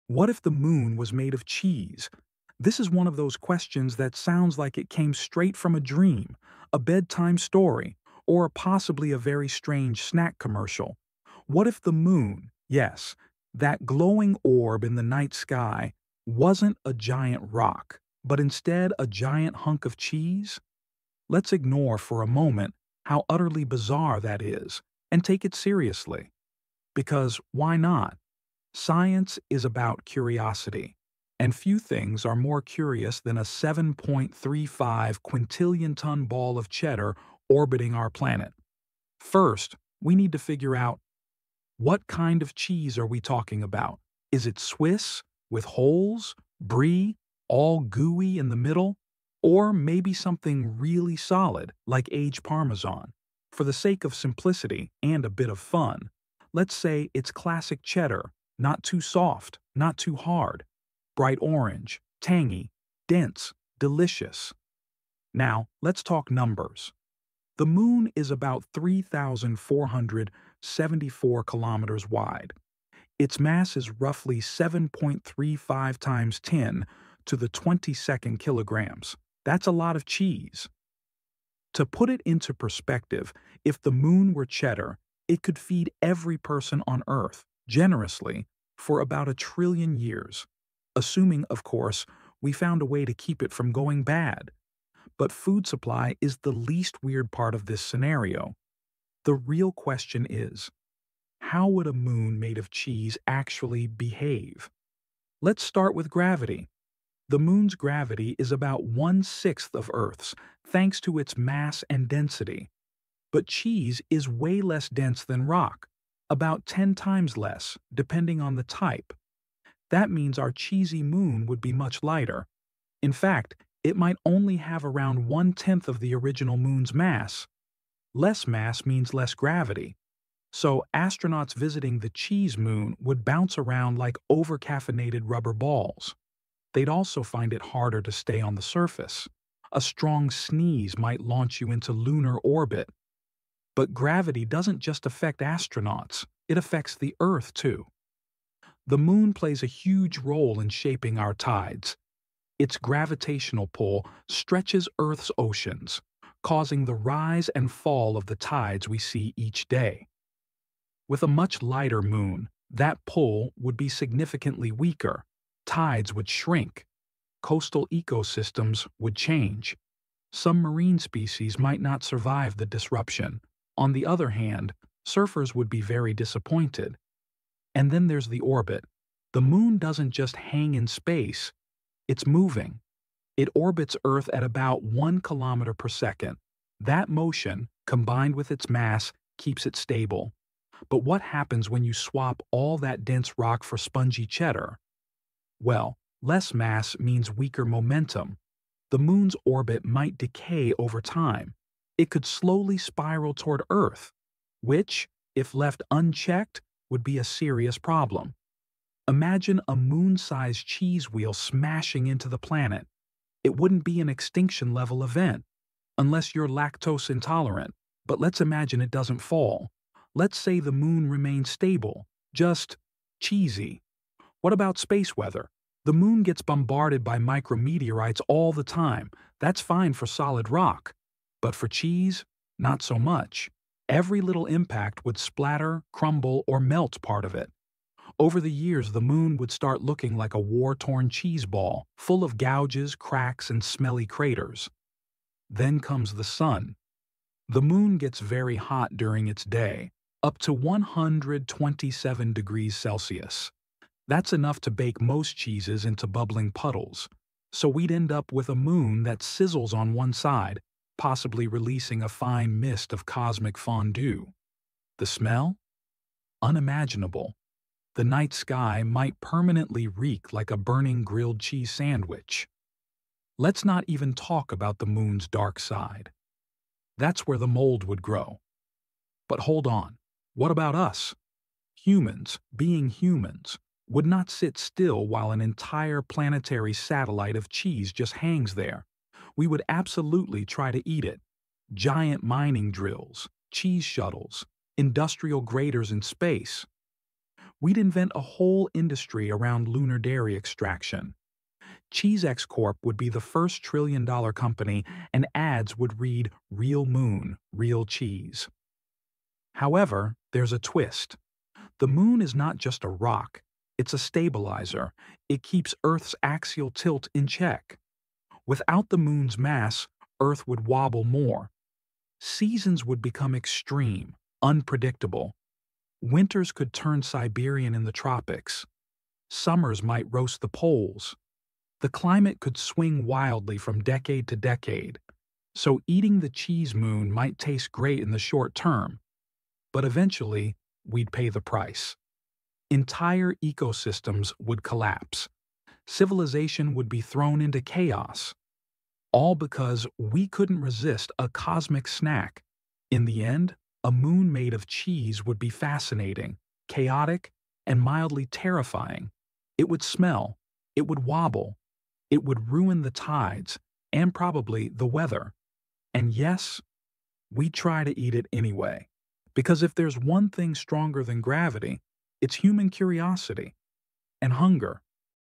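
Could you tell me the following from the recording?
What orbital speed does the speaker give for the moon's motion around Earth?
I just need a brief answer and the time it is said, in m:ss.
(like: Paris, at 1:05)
1 kilometer per second, at 3:04.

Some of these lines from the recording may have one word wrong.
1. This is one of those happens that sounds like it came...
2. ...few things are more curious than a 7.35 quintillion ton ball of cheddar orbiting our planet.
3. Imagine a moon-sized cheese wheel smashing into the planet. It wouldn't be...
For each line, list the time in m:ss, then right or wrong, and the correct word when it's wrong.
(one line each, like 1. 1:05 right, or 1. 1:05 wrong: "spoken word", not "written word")
1. 0:02 wrong: "questions", not "happens"
2. 0:31 right
3. 3:29 right.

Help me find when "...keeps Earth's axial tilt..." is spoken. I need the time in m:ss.
5:15.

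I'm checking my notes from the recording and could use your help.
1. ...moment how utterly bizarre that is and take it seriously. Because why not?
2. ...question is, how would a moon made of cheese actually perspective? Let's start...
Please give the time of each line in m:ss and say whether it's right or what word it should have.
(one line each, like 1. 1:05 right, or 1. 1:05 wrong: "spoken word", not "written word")
1. 0:22 right
2. 1:39 wrong: "behave", not "perspective".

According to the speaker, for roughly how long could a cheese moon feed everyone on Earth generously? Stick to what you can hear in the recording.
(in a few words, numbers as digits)
about a trillion years.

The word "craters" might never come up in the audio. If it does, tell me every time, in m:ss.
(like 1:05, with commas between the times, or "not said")
4:04.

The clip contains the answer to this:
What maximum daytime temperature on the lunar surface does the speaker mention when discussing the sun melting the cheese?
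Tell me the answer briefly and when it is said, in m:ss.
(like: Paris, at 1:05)
127 degrees Celsius, at 4:10.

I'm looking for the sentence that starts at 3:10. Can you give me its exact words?
But what happens when you swap all that dense rock for spongy cheddar?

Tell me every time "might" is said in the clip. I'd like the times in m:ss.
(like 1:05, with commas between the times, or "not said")
2:03, 2:20, 2:51, 3:19, 4:28, 5:29, 5:37.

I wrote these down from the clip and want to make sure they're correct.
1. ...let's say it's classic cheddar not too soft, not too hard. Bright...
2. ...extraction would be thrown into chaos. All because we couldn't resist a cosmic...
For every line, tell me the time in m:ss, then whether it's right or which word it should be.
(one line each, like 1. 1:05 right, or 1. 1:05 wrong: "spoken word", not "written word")
1. 0:56 right
2. 5:45 wrong: "civilization", not "extraction".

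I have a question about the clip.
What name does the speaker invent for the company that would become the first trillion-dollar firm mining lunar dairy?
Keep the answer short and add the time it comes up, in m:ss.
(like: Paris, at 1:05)
CheeseX Corp, at 5:01.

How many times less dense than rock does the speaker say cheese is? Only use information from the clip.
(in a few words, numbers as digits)
10 times.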